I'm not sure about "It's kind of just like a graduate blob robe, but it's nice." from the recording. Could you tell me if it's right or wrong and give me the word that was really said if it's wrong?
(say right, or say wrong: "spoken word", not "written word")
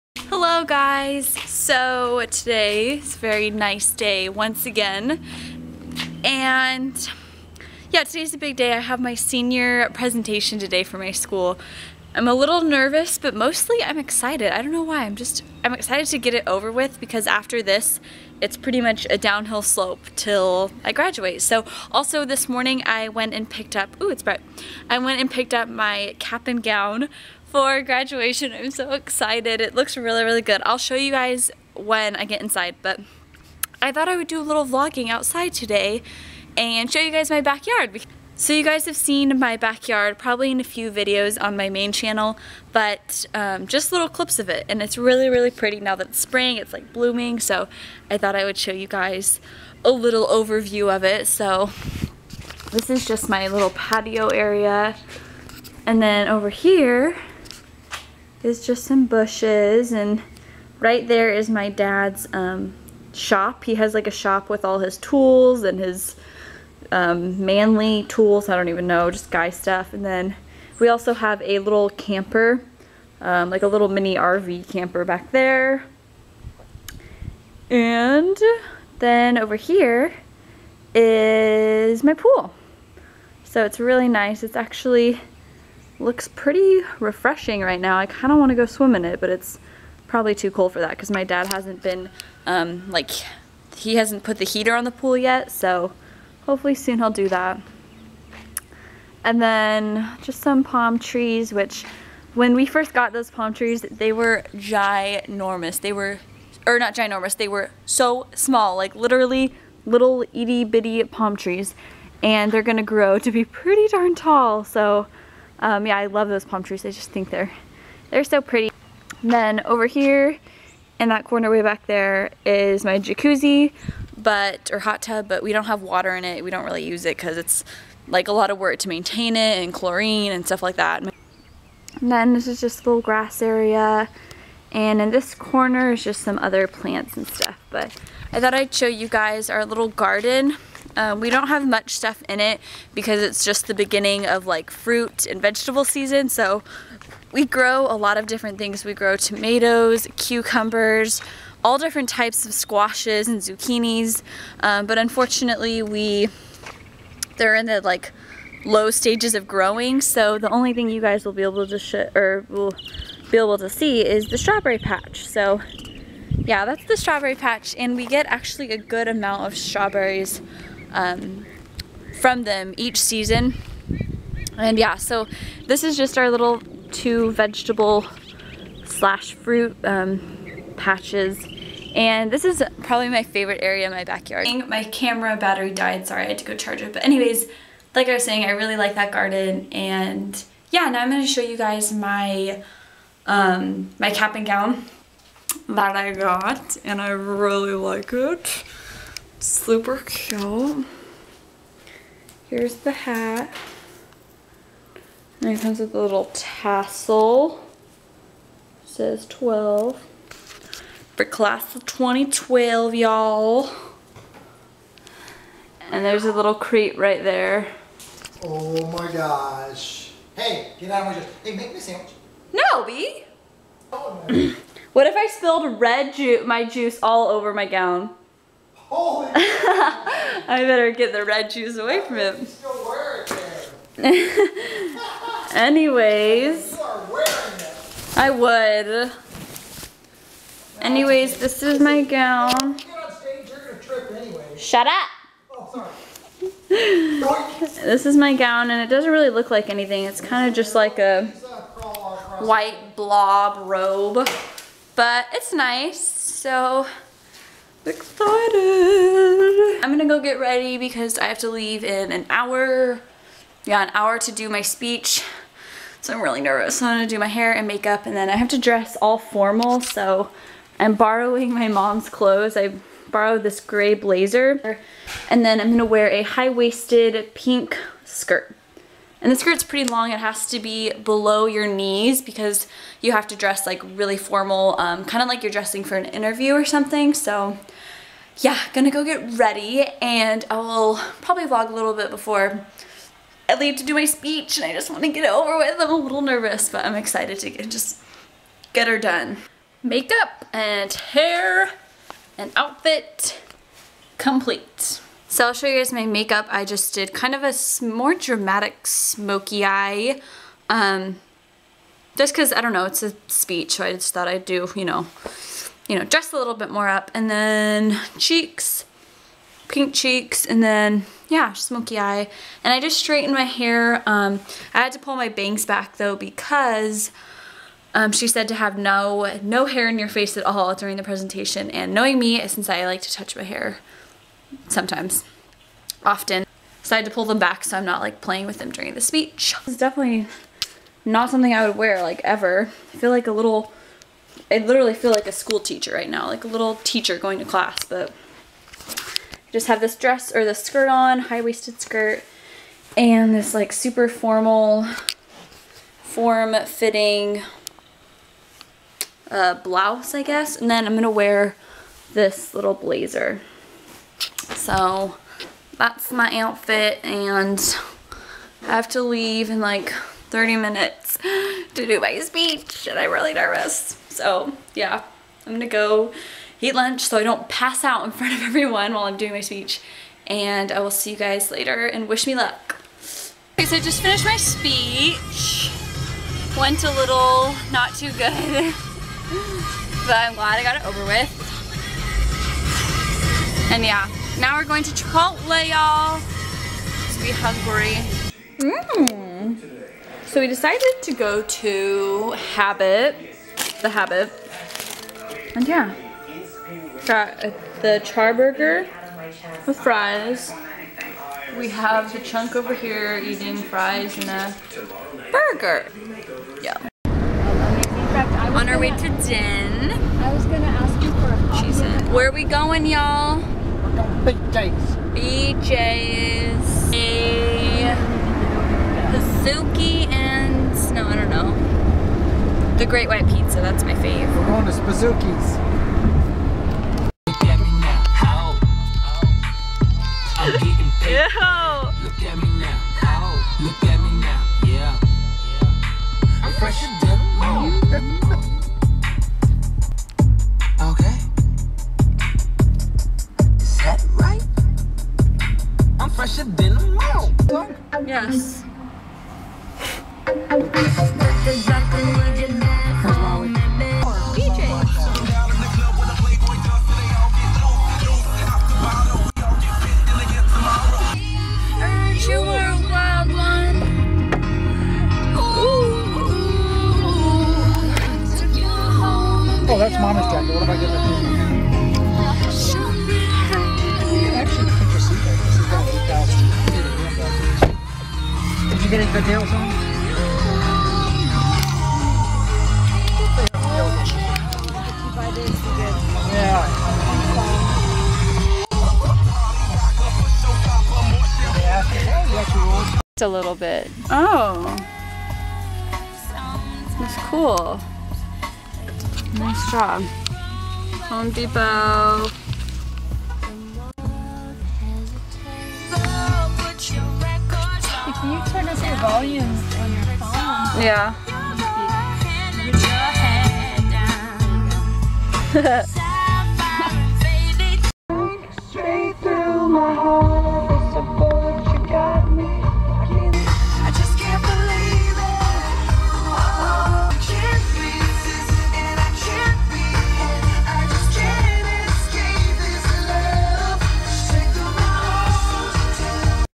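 wrong: "white", not "graduate".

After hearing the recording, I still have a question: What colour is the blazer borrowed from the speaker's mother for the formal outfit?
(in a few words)
gray.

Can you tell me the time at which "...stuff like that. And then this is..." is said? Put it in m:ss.
2:10.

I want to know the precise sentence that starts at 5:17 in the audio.
And then cheeks, pink cheeks, and then, yeah, smoky eye.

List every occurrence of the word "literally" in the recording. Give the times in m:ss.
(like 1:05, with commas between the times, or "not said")
1:48, 5:44.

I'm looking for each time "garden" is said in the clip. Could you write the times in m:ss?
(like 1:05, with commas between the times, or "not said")
2:19, 3:09.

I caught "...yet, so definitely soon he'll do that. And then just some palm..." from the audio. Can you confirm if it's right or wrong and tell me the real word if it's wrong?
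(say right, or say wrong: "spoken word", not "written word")
wrong: "hopefully", not "definitely".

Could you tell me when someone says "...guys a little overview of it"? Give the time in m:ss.
0:48.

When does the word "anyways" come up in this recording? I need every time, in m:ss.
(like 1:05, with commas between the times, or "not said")
3:07, 3:55, 4:00.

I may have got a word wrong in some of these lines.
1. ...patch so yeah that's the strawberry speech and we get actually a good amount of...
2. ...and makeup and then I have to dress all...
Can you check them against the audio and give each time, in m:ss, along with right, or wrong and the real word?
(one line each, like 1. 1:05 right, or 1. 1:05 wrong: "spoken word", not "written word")
1. 2:44 wrong: "patch", not "speech"
2. 4:27 right.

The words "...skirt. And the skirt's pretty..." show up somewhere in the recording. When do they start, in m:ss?
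4:38.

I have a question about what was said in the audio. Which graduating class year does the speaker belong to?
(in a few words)
2012.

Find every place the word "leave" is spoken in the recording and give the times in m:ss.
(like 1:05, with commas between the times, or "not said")
4:21, 4:53, 6:09.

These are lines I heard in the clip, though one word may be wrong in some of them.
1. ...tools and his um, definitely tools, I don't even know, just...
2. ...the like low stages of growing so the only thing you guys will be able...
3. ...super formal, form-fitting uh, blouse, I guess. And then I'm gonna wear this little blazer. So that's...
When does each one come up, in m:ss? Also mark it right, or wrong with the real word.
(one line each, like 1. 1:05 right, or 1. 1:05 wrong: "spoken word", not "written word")
1. 1:04 wrong: "manly", not "definitely"
2. 2:37 right
3. 5:53 right.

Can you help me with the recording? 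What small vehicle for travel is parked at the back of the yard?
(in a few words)
mini RV camper.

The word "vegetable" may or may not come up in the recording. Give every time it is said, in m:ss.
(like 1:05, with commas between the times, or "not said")
2:25, 2:57.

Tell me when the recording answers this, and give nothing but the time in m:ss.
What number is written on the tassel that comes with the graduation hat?
3:29.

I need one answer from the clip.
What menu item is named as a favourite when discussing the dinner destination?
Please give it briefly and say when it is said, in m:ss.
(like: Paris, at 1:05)
The Great White Pizza, at 7:12.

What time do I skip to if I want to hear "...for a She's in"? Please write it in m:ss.
7:01.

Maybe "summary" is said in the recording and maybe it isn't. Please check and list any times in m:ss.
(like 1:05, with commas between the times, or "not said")
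not said.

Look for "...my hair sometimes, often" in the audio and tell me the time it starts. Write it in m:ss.
5:33.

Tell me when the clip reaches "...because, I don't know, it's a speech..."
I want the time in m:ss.
5:12.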